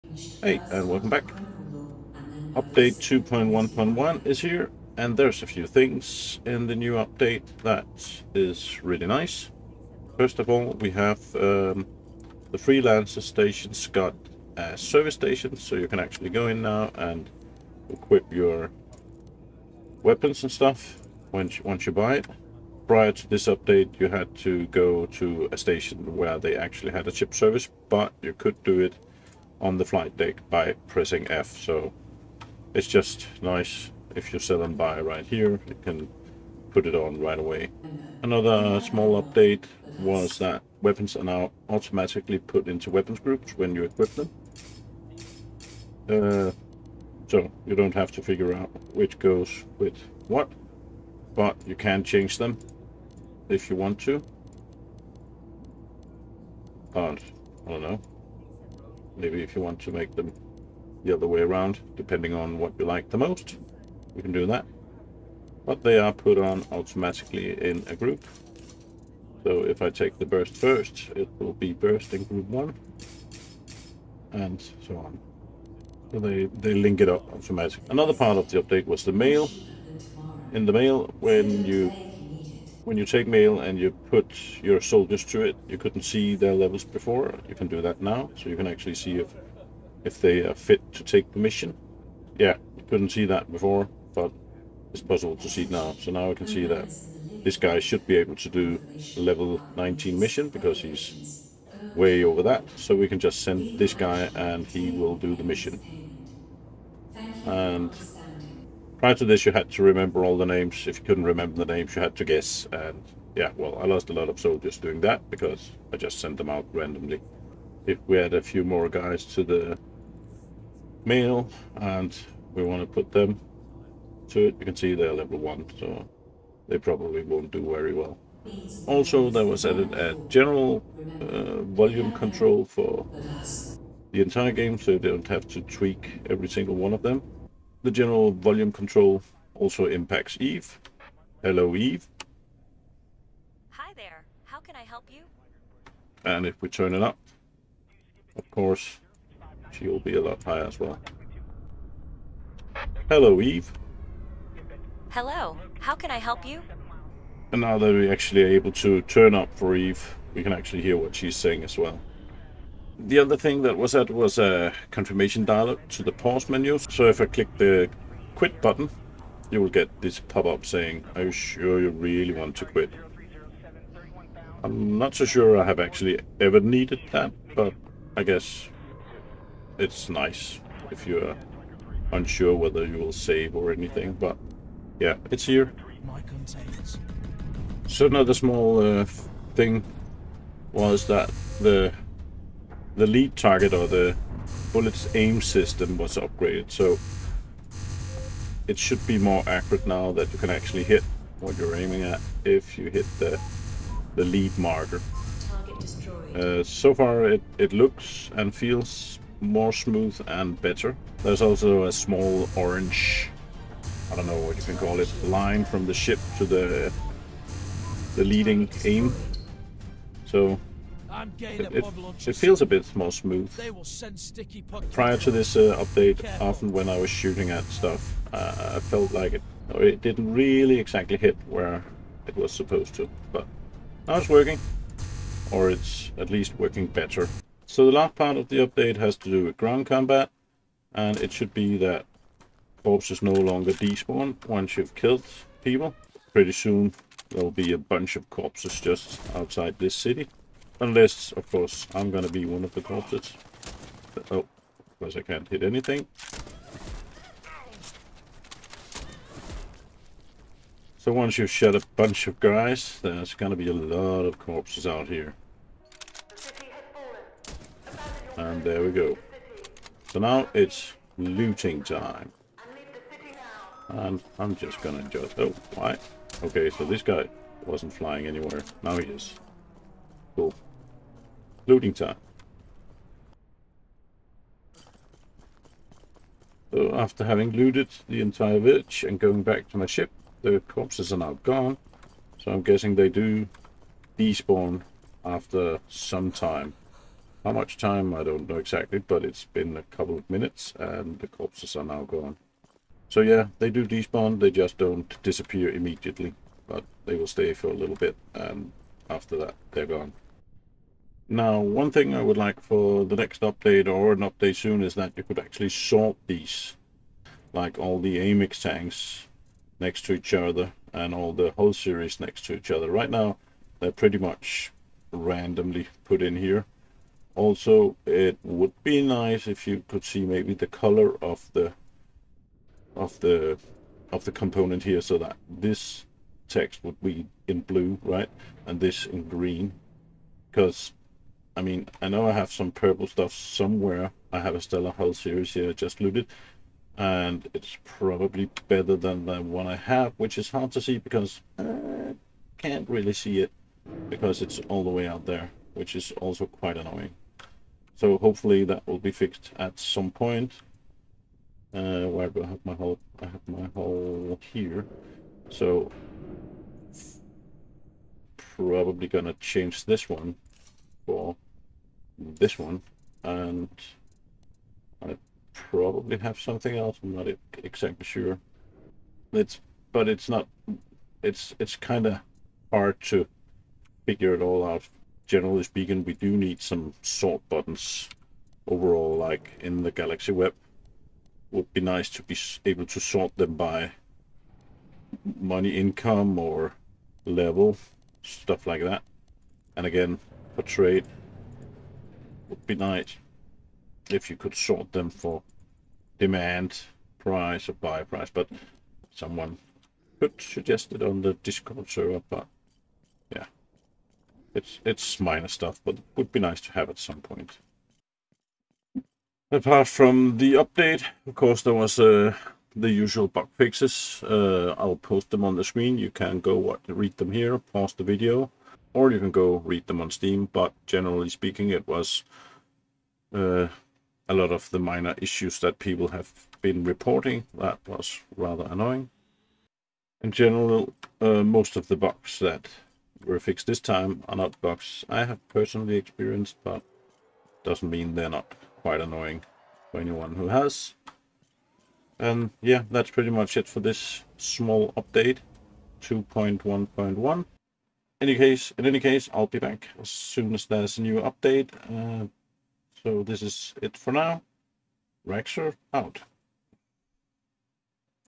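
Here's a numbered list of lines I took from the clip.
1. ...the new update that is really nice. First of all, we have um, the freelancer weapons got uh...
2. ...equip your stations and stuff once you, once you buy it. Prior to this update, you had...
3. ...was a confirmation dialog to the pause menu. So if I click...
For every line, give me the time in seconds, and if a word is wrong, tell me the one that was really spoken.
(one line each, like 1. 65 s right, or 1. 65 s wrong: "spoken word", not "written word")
1. 6 s wrong: "stations", not "weapons"
2. 17 s wrong: "weapons", not "stations"
3. 164 s right.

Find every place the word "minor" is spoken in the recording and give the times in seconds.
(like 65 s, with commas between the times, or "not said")
415 s, 434 s.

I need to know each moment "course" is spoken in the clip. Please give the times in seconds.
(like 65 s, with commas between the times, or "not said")
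148 s, 251 s, 421 s.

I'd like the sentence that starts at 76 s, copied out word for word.
So they, they link it up automatically.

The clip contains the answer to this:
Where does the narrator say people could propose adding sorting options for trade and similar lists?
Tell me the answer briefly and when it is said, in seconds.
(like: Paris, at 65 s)
Discord server, at 411 s.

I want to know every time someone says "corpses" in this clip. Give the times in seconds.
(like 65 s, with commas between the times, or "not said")
242 s, 248 s, 252 s, 264 s, 290 s, 301 s.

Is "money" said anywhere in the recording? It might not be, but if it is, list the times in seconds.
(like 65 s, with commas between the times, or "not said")
395 s.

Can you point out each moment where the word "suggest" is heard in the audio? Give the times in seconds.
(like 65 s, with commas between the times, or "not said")
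410 s.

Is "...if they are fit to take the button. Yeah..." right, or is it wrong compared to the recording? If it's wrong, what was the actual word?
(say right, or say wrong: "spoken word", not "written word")
wrong: "mission", not "button".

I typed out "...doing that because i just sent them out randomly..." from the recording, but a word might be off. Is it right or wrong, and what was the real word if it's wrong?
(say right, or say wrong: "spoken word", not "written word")
right.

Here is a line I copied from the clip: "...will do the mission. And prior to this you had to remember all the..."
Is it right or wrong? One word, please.
right.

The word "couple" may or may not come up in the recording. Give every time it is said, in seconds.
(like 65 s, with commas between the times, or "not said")
299 s.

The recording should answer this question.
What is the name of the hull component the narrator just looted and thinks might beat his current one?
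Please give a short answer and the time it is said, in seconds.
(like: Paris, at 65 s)
Stellar Hull series, at 344 s.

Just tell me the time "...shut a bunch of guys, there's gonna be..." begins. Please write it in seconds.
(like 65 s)
261 s.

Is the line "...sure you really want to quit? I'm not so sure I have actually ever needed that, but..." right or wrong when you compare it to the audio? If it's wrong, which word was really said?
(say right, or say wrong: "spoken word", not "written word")
right.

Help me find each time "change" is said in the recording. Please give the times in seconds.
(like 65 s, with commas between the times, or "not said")
52 s, 369 s.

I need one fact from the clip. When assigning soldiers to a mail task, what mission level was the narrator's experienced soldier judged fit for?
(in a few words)
19.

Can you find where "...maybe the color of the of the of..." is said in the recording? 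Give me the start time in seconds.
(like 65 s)
330 s.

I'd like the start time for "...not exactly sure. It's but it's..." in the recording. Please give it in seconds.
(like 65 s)
377 s.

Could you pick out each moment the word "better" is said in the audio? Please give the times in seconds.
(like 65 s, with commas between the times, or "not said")
210 s, 236 s, 348 s.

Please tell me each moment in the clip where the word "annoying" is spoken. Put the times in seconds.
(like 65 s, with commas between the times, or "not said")
356 s, 438 s, 449 s.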